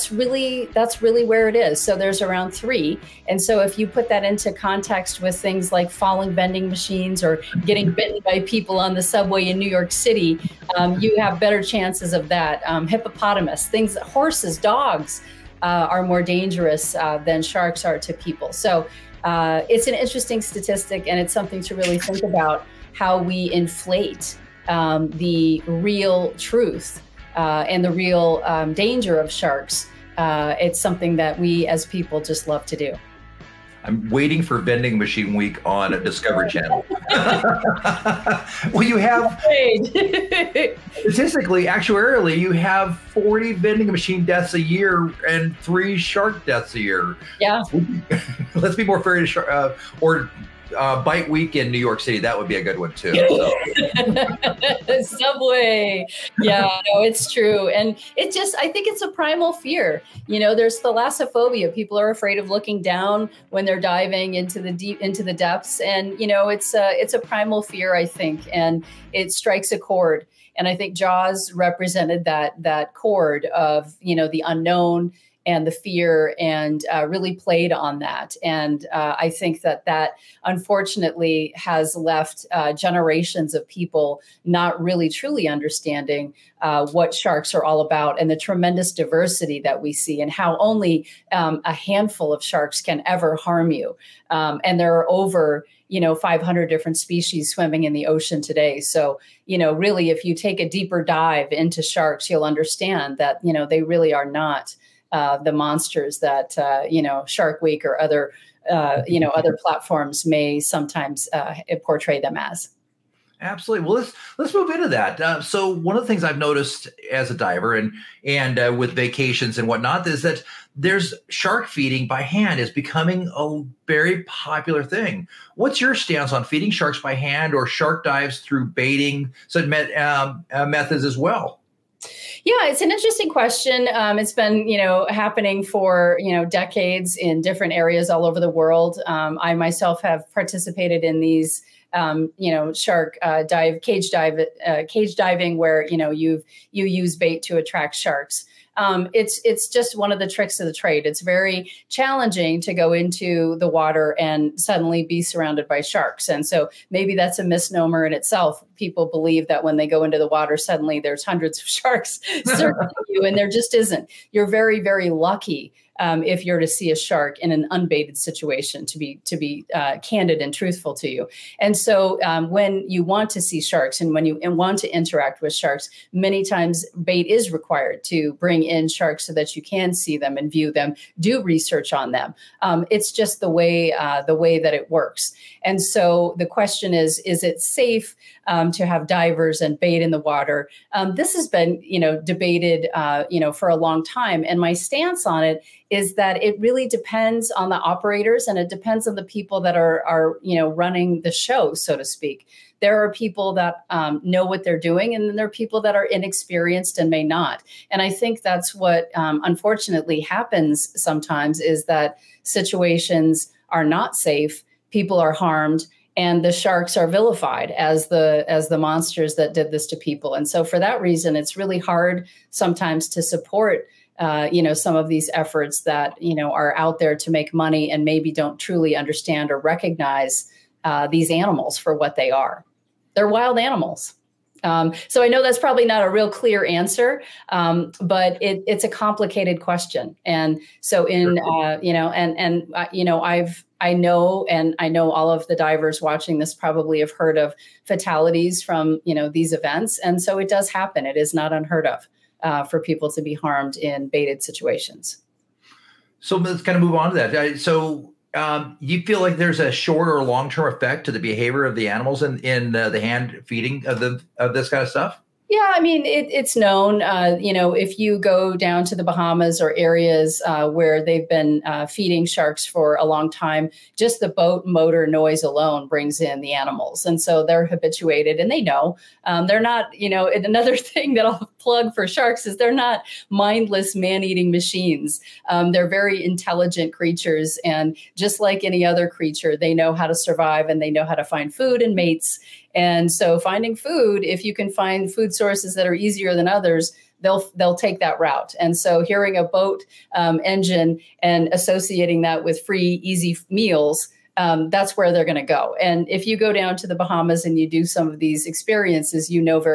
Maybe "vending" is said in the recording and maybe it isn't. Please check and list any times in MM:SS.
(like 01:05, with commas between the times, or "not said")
00:06, 00:34, 00:43.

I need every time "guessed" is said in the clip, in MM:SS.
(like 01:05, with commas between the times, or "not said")
not said.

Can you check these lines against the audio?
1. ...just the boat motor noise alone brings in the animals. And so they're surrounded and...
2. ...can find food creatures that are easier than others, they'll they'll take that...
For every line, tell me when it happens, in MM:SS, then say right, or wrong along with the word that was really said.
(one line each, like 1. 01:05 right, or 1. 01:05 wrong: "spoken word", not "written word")
1. 04:33 wrong: "habituated", not "surrounded"
2. 04:54 wrong: "sources", not "creatures".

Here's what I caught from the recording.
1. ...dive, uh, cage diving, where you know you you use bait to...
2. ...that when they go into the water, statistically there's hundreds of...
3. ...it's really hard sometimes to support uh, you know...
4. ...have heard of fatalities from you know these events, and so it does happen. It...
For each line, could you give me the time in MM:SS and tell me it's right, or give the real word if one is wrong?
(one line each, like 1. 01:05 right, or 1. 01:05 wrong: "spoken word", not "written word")
1. 02:24 right
2. 02:39 wrong: "suddenly", not "statistically"
3. 03:41 right
4. 04:07 right.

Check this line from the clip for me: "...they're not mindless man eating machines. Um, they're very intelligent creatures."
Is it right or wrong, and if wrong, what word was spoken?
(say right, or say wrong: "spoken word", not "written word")
right.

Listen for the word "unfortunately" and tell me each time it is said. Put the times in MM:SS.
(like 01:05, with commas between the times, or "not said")
01:20, 03:29.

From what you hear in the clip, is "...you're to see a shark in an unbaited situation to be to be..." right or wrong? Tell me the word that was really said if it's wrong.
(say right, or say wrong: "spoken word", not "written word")
right.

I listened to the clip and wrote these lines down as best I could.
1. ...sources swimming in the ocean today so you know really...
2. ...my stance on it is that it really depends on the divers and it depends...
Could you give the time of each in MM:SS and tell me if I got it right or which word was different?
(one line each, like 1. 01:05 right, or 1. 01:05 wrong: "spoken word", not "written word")
1. 01:36 wrong: "species", not "sources"
2. 03:14 wrong: "operators", not "divers".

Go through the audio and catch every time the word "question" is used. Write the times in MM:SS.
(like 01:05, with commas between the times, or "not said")
02:13, 03:06, 03:59.